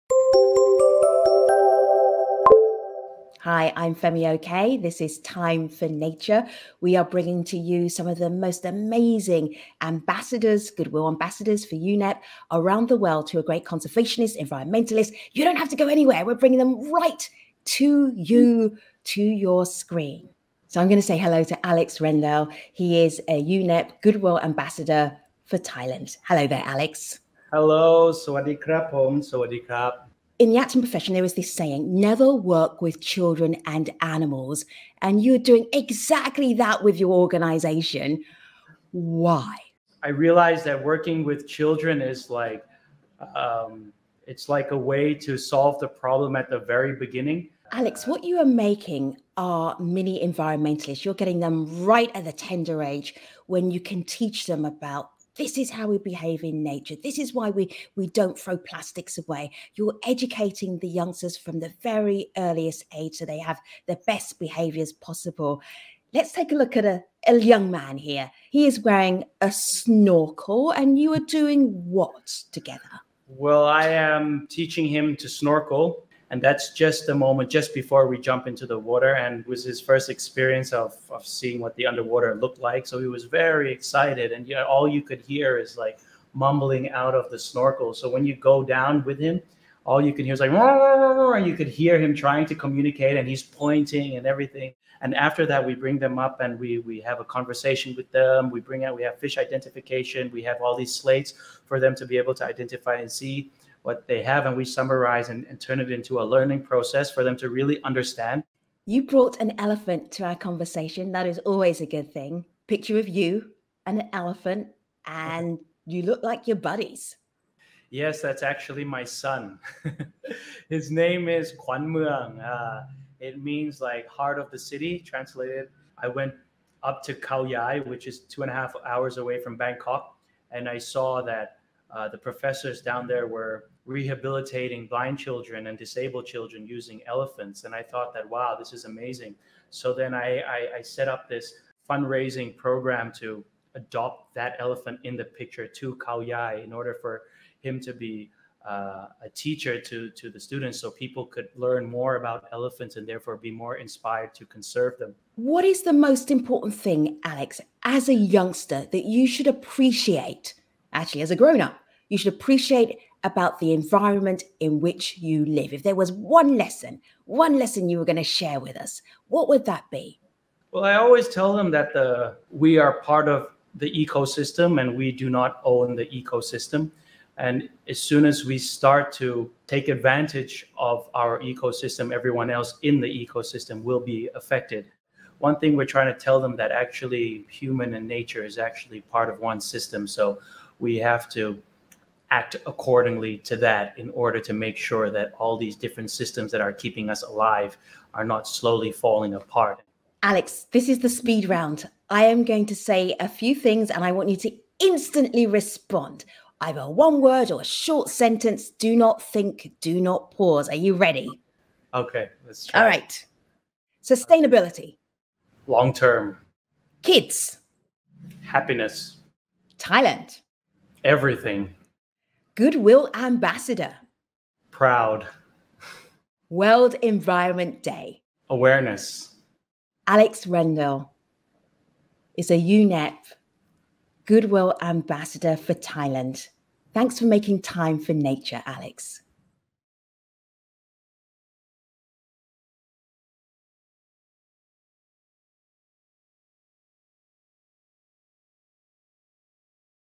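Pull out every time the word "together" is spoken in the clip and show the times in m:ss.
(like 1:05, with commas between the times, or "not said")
1:12.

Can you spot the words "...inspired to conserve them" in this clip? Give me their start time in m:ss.
2:33.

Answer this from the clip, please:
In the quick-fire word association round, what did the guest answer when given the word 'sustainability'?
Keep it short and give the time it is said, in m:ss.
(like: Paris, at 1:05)
Long term, at 3:35.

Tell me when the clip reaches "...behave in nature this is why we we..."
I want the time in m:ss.
0:55.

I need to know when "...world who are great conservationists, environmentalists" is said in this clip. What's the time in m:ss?
0:12.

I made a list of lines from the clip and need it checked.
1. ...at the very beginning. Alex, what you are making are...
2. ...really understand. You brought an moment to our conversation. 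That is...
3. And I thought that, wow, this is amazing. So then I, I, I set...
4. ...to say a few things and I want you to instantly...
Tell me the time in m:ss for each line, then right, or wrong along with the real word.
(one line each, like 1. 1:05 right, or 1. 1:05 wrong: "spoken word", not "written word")
1. 0:46 right
2. 1:47 wrong: "elephant", not "moment"
3. 2:17 right
4. 3:22 right.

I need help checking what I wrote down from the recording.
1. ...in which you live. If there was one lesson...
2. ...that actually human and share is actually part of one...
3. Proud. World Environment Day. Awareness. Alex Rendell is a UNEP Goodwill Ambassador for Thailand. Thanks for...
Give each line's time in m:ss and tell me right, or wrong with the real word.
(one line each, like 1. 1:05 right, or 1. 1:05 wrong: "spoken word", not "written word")
1. 2:44 right
2. 3:06 wrong: "nature", not "share"
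3. 3:44 right.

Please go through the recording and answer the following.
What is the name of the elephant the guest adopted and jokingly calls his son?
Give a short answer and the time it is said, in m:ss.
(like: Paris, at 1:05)
Quan Muang, at 2:01.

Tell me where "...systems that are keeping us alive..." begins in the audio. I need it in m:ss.
3:16.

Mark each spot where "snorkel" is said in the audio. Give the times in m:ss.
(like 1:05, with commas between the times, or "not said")
1:09, 1:15, 1:27.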